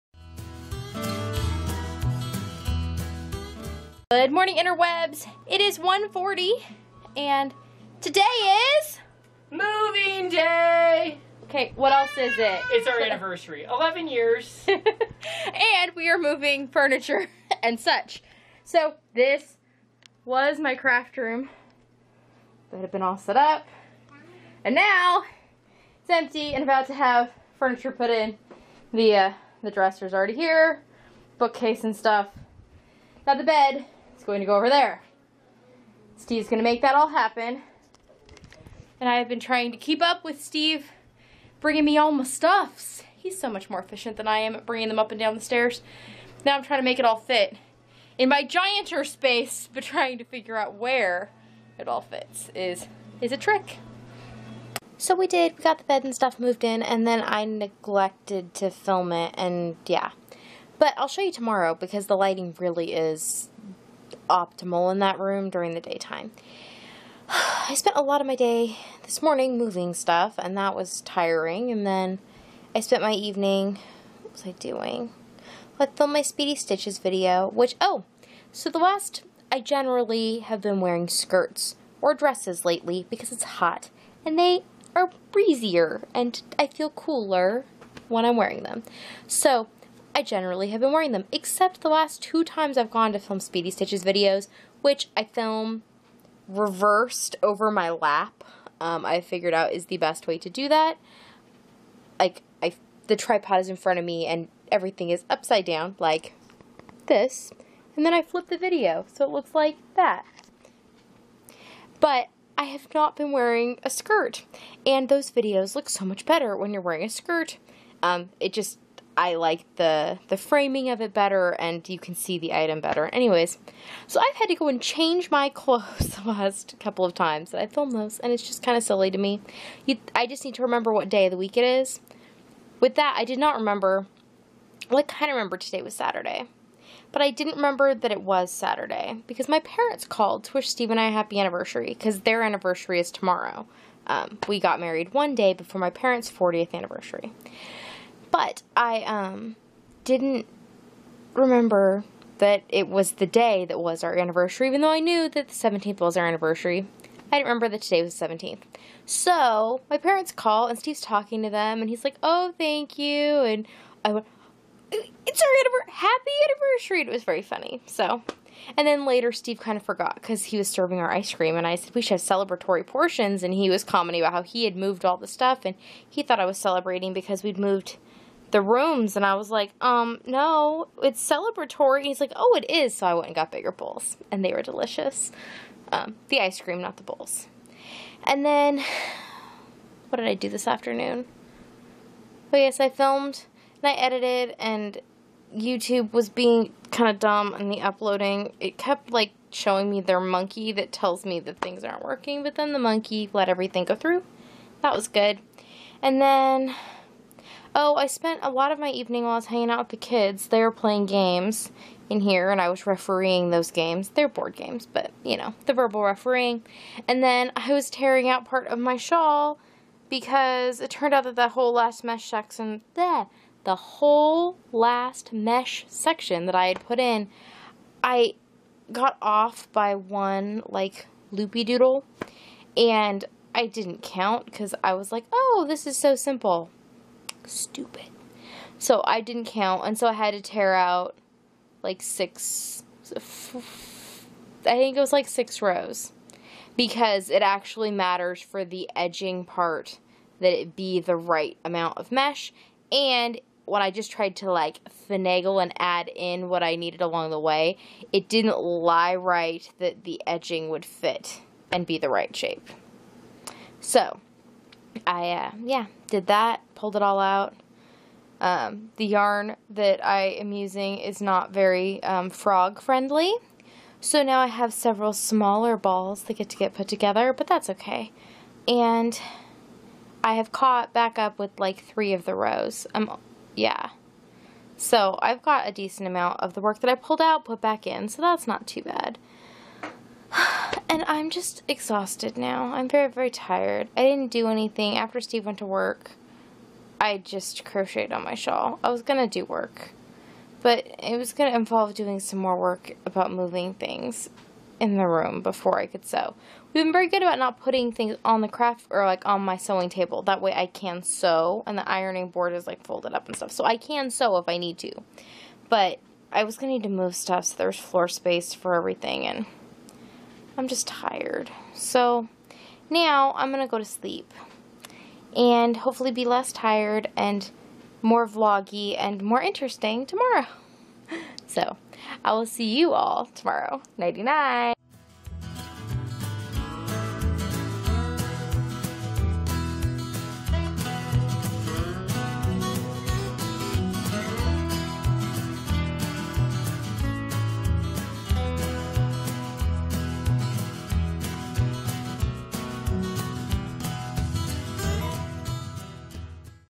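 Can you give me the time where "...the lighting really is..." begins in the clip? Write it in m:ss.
1:02.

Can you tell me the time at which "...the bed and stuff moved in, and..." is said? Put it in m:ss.
0:55.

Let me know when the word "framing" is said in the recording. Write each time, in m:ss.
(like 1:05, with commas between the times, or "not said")
2:00.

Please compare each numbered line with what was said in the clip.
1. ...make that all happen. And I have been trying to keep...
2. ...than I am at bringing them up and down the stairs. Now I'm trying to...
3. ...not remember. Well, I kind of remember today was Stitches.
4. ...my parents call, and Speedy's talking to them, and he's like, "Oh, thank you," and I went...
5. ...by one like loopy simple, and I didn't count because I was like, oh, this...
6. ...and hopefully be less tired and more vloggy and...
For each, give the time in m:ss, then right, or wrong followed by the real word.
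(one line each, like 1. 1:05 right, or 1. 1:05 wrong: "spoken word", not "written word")
1. 0:36 right
2. 0:44 right
3. 2:13 wrong: "Saturday", not "Stitches"
4. 2:39 wrong: "Steve", not "Speedy"
5. 3:49 wrong: "doodle", not "simple"
6. 5:25 right.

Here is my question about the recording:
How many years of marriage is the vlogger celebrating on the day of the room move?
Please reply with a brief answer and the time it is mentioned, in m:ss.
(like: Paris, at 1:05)
11, at 0:13.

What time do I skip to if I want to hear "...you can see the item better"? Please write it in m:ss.
2:01.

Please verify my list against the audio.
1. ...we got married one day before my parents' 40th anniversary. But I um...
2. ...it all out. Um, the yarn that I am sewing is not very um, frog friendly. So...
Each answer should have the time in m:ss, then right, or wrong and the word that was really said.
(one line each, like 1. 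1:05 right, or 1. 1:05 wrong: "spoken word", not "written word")
1. 2:24 right
2. 4:26 wrong: "using", not "sewing".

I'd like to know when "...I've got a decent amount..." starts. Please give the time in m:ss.
4:45.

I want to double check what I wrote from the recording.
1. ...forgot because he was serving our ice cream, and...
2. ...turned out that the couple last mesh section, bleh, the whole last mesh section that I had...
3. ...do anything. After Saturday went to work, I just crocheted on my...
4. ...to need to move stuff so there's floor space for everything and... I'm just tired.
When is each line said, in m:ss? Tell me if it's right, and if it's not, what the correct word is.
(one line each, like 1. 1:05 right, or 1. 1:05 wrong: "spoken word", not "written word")
1. 2:49 right
2. 3:40 wrong: "whole", not "couple"
3. 4:54 wrong: "Steve", not "Saturday"
4. 5:16 right.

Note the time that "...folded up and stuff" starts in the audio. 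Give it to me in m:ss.
5:12.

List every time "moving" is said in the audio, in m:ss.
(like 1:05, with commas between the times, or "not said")
0:09, 0:16, 1:09, 5:03.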